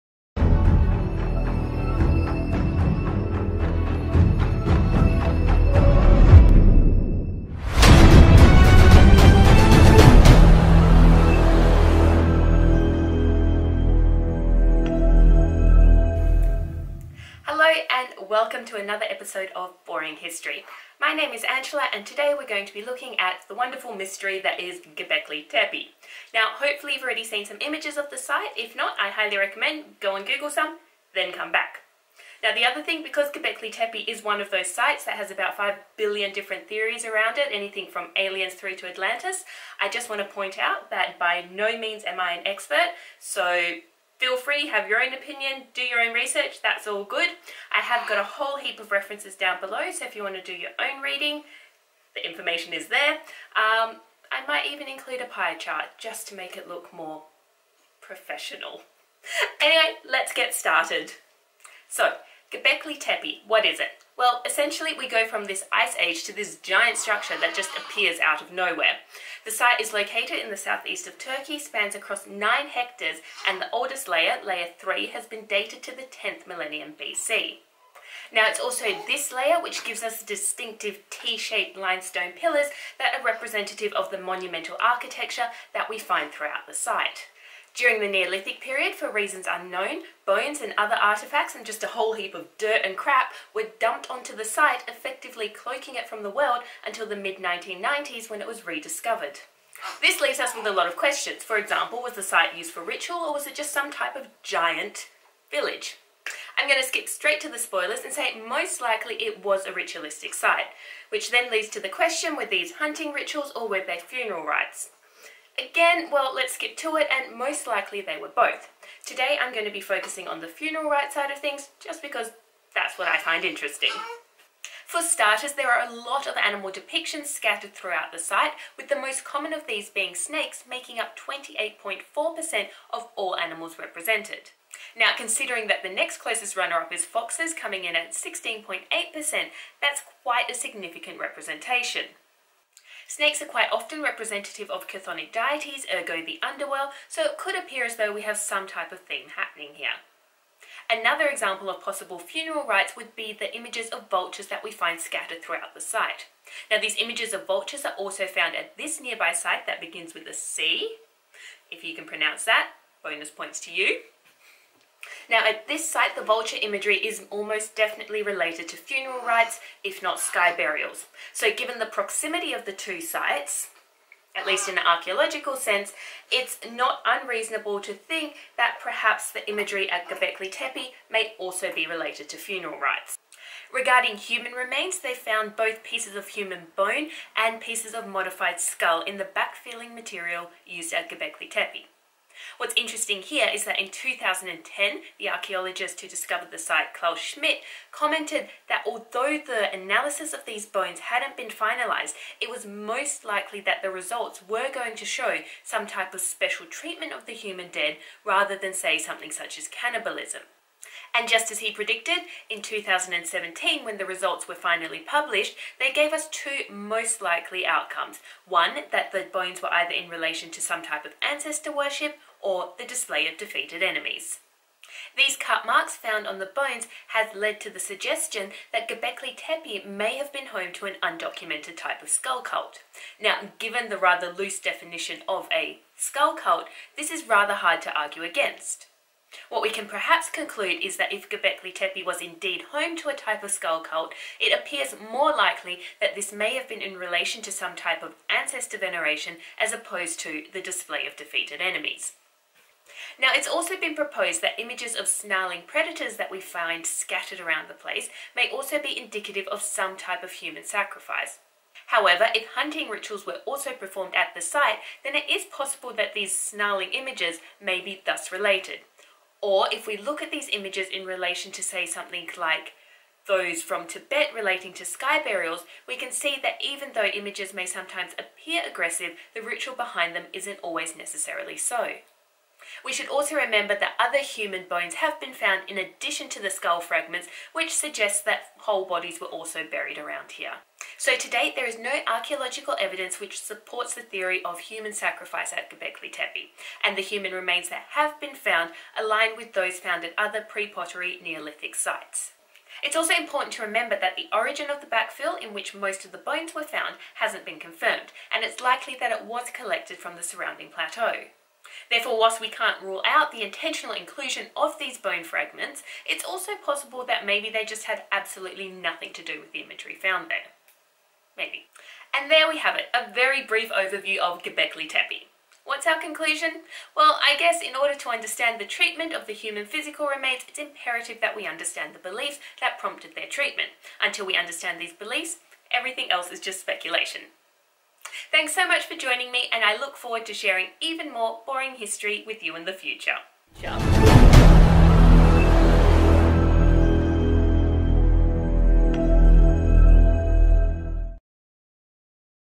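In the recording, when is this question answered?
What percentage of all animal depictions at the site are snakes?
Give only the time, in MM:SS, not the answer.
02:11.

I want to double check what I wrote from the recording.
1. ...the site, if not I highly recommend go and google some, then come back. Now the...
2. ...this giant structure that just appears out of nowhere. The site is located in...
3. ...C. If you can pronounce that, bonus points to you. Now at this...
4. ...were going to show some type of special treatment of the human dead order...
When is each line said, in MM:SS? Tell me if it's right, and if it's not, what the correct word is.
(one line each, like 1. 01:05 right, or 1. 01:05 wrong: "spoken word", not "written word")
1. 00:28 right
2. 01:06 right
3. 02:40 right
4. 03:24 wrong: "rather", not "order".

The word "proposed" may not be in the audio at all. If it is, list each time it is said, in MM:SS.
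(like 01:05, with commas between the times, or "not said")
04:13.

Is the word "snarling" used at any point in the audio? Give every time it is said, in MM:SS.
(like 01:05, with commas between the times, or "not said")
04:15, 04:26.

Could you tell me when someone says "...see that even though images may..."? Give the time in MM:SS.
04:36.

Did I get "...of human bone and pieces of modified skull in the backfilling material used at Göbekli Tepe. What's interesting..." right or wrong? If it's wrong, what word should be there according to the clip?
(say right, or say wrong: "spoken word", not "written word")
right.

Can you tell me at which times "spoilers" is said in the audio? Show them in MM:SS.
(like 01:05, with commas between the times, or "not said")
01:47.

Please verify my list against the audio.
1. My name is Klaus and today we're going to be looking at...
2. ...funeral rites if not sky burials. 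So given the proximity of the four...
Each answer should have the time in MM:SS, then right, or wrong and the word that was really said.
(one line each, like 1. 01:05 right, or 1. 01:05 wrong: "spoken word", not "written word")
1. 00:20 wrong: "Angela", not "Klaus"
2. 02:48 wrong: "two", not "four".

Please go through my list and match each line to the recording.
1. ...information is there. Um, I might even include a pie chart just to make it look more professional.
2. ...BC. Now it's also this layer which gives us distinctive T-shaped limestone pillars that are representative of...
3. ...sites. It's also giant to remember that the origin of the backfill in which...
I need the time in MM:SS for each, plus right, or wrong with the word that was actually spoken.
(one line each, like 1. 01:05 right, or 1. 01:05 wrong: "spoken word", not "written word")
1. 00:52 right
2. 01:17 right
3. 05:01 wrong: "important", not "giant".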